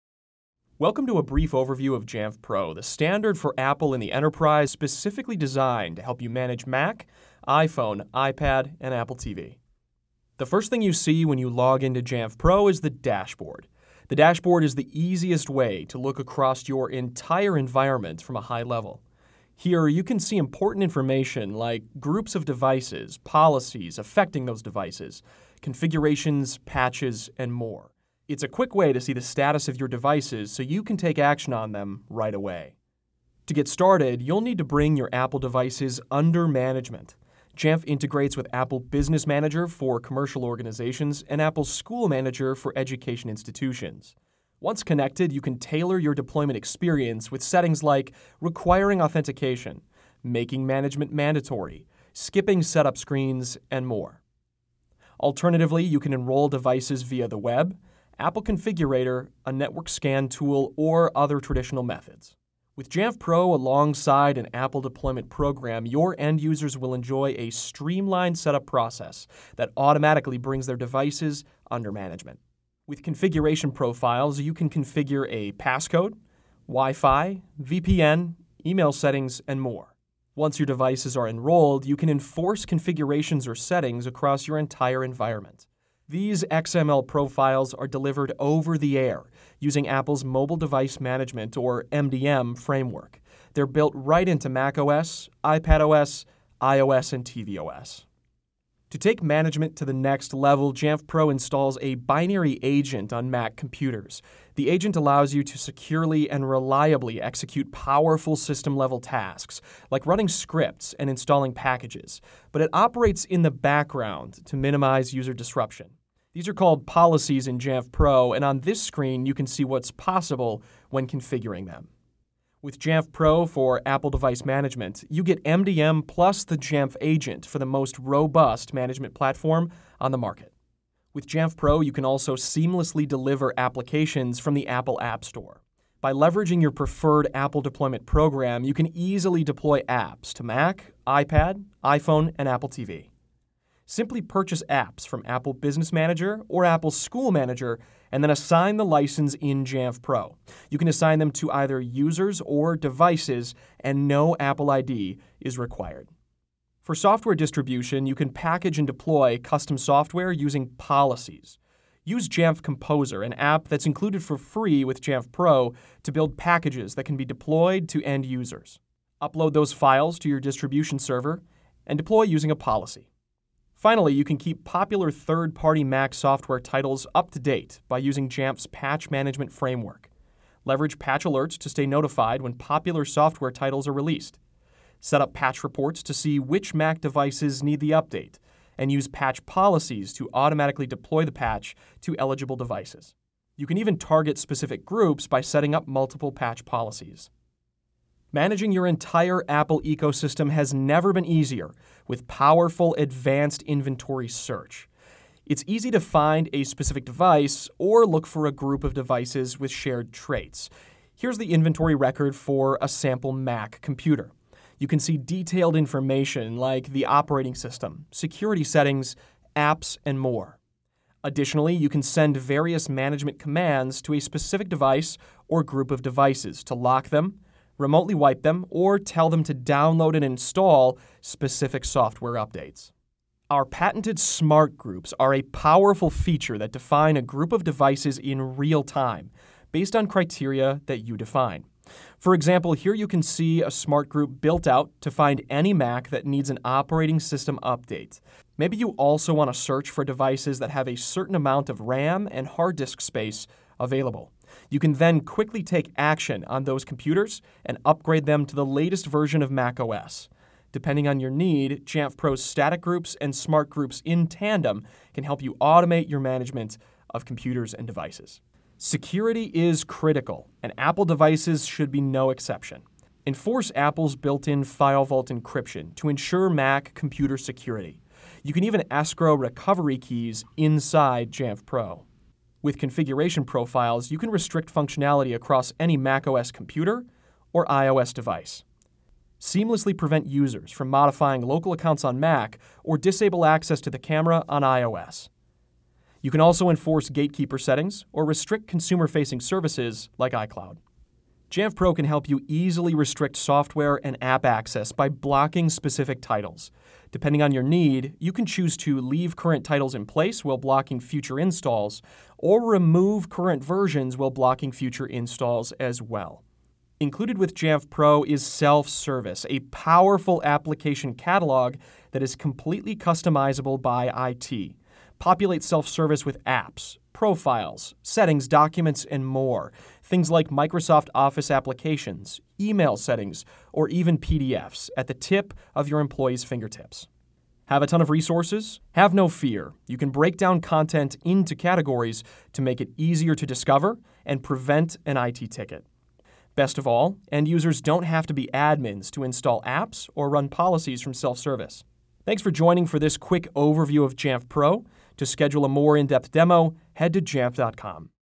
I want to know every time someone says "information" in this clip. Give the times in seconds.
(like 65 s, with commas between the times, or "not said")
20 s, 215 s.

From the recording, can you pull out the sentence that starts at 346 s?
Best of all, end users don't have to be admins to install apps or run policies from self service.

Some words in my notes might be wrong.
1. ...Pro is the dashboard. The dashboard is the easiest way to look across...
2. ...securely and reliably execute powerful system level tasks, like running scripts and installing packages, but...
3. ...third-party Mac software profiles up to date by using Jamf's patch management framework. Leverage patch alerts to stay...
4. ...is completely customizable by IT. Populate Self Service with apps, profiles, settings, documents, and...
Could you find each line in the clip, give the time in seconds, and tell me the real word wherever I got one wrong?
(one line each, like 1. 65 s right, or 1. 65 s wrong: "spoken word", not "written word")
1. 12 s right
2. 105 s right
3. 175 s wrong: "titles", not "profiles"
4. 322 s right.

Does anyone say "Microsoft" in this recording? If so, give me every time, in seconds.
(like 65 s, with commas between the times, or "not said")
330 s.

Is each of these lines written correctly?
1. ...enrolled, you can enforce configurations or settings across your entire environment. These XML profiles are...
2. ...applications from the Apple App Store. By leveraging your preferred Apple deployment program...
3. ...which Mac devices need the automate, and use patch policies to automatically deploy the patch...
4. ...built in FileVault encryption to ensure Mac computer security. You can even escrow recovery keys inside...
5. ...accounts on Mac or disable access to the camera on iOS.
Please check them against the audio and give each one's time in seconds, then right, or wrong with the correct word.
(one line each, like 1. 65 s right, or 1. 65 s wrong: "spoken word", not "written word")
1. 81 s right
2. 133 s right
3. 186 s wrong: "update", not "automate"
4. 274 s right
5. 291 s right.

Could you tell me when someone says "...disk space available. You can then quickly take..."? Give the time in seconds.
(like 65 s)
252 s.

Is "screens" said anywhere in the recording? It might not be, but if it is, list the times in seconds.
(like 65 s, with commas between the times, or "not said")
52 s, 118 s.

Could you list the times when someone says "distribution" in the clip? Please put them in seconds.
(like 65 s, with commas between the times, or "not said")
157 s, 170 s.